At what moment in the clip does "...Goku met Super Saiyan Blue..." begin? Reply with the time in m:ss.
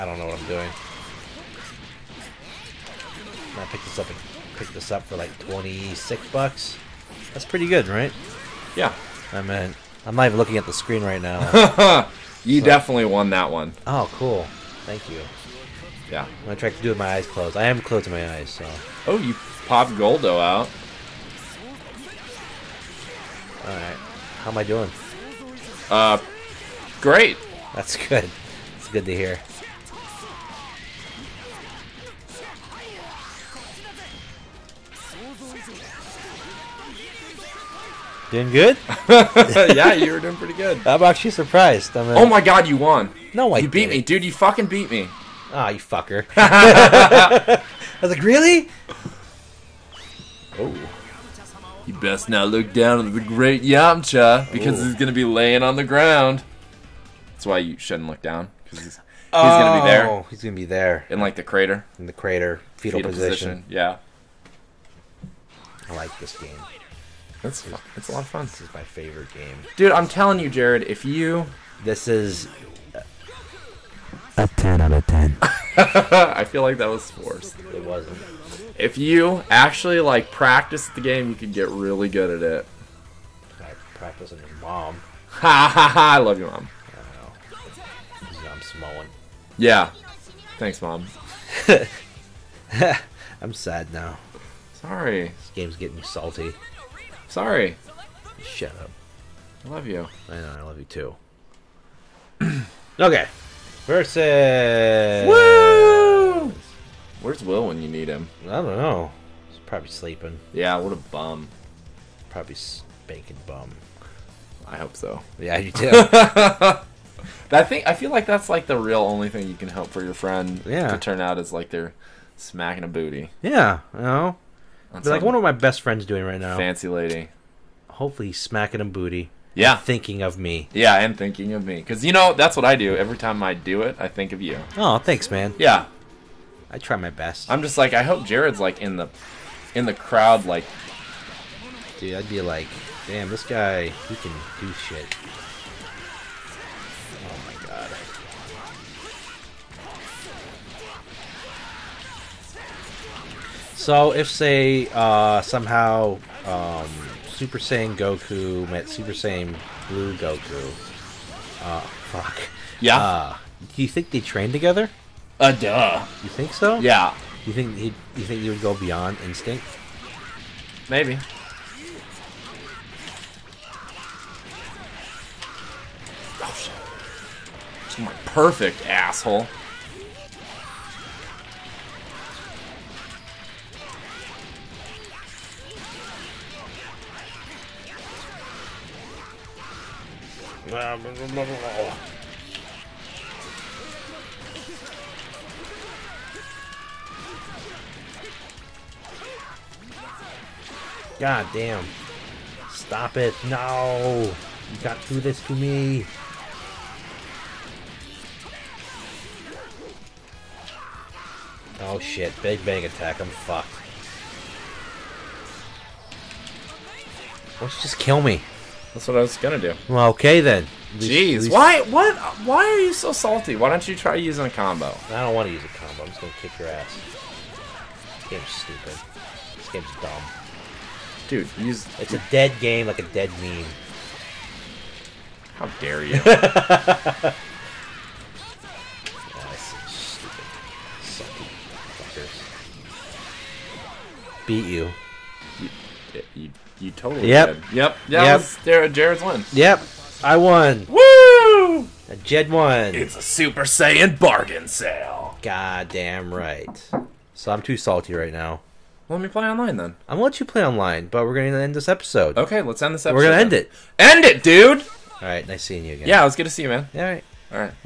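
2:37.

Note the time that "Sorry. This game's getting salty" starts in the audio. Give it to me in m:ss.
1:34.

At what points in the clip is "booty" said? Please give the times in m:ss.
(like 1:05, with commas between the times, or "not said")
2:02, 2:08.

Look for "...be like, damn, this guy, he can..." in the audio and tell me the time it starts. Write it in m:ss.
2:22.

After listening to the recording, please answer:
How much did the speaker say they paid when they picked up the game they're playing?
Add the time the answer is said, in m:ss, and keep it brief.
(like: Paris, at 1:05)
$26, at 0:05.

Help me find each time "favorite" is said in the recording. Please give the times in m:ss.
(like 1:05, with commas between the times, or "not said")
1:08.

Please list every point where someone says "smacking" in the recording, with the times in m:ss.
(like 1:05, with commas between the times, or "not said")
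2:02, 2:08.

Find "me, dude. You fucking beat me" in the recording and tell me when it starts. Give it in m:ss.
0:43.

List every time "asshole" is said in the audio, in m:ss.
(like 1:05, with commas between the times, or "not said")
2:58.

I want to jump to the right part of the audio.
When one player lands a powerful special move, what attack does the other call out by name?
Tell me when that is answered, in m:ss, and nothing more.
3:32.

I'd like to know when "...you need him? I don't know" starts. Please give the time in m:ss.
1:47.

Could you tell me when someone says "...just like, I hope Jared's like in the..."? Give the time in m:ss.
2:17.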